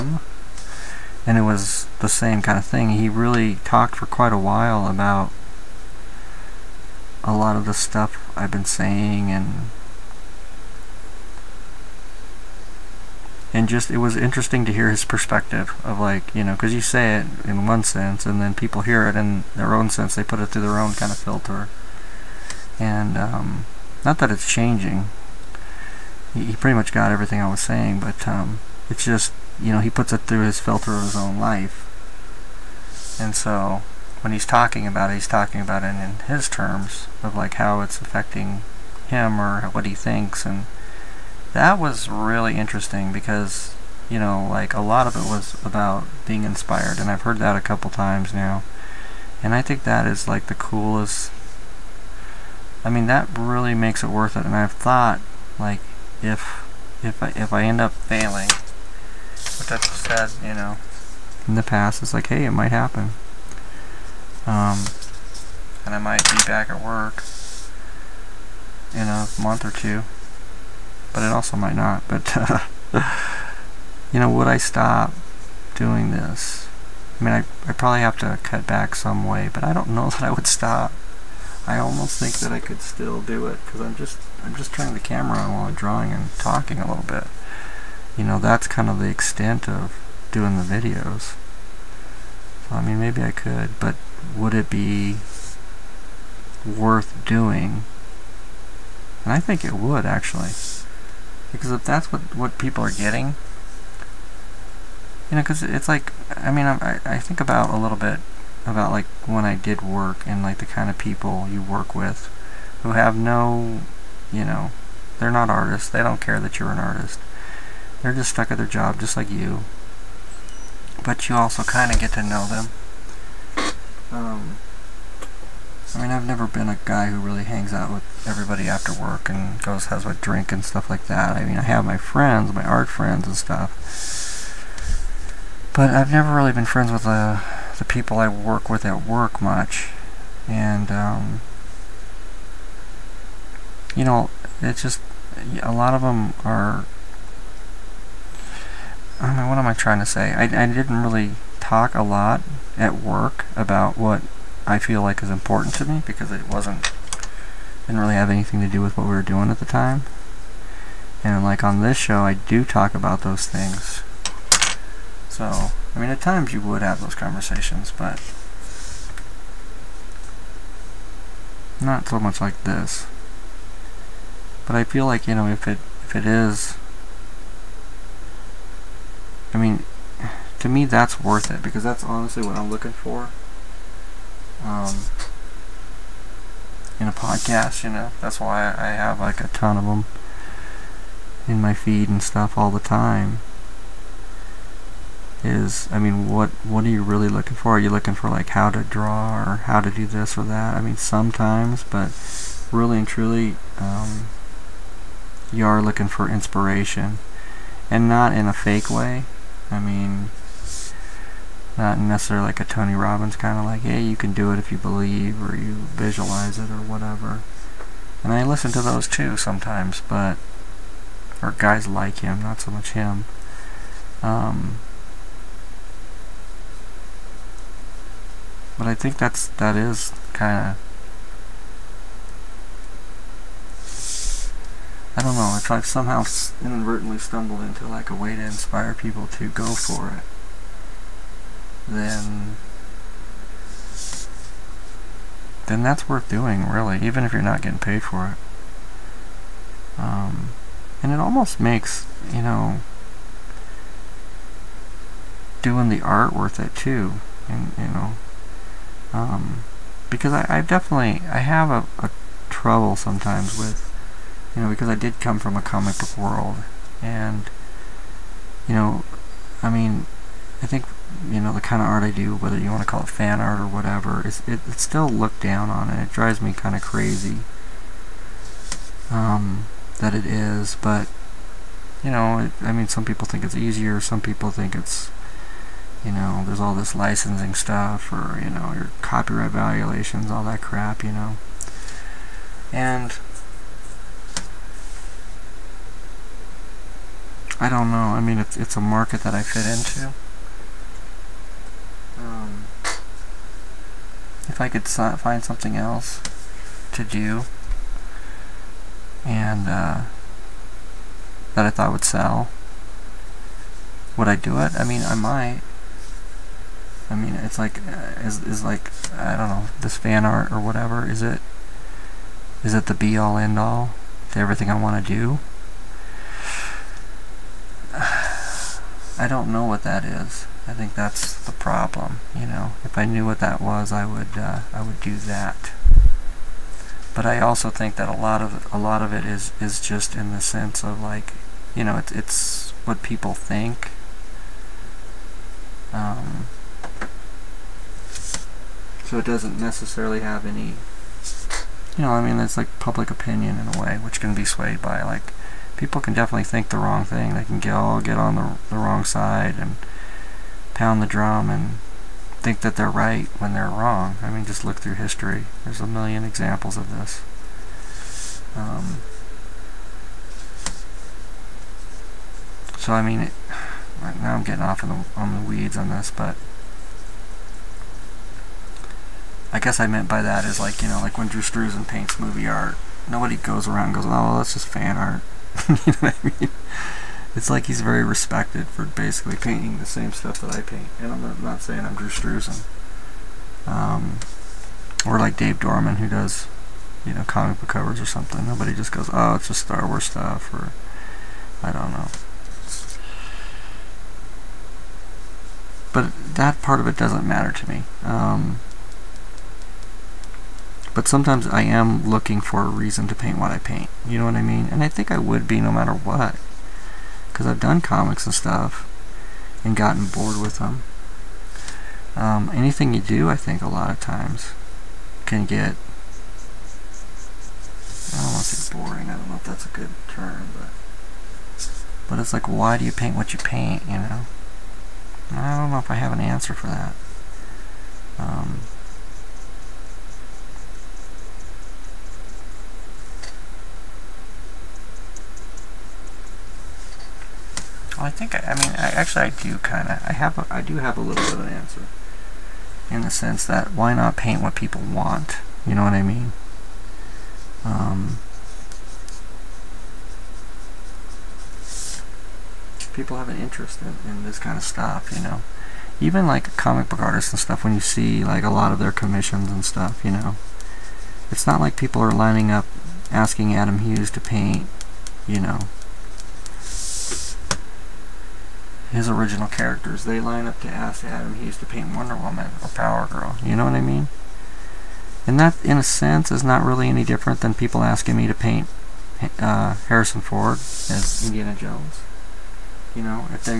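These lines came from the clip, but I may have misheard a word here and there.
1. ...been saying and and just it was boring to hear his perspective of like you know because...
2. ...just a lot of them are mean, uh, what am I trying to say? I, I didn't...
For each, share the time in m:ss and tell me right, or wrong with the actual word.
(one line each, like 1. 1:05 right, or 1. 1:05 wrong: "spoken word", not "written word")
1. 0:08 wrong: "interesting", not "boring"
2. 2:24 right.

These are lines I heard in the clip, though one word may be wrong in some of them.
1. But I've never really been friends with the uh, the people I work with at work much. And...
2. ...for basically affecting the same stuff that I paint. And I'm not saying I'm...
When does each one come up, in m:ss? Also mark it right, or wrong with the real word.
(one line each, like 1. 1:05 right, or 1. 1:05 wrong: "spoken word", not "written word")
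1. 2:15 right
2. 6:28 wrong: "painting", not "affecting".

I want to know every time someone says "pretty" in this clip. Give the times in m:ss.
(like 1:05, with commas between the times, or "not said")
0:26.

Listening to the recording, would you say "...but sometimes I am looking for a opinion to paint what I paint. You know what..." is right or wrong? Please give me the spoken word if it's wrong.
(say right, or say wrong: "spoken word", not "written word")
wrong: "reason", not "opinion".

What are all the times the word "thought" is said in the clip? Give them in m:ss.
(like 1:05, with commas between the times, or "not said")
0:54, 5:11.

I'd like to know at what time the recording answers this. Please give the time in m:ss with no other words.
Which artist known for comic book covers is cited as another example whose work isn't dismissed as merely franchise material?
6:35.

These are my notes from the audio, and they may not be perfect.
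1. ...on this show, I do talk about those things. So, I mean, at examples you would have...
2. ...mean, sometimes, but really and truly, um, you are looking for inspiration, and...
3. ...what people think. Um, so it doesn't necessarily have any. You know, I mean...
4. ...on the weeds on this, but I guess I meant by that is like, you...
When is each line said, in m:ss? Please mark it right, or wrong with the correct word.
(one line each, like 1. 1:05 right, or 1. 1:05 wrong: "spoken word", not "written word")
1. 2:41 wrong: "times", not "examples"
2. 3:20 right
3. 5:42 right
4. 6:15 right.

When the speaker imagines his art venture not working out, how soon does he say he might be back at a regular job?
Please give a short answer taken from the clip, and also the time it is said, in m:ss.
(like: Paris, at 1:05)
a month or two, at 1:08.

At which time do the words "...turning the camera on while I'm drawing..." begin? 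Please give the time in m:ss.
1:24.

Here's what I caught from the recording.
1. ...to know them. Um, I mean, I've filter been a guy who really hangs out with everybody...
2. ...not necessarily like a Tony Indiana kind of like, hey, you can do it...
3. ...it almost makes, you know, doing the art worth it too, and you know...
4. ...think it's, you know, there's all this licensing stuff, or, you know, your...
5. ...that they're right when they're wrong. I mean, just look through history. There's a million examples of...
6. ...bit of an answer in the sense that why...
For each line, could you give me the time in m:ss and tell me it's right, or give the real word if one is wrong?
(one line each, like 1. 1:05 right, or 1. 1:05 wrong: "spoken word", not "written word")
1. 2:02 wrong: "never", not "filter"
2. 3:31 wrong: "Robbins", not "Indiana"
3. 4:11 right
4. 4:44 right
5. 6:02 right
6. 7:31 right.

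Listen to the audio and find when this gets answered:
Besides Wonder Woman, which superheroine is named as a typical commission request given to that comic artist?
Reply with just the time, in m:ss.
8:02.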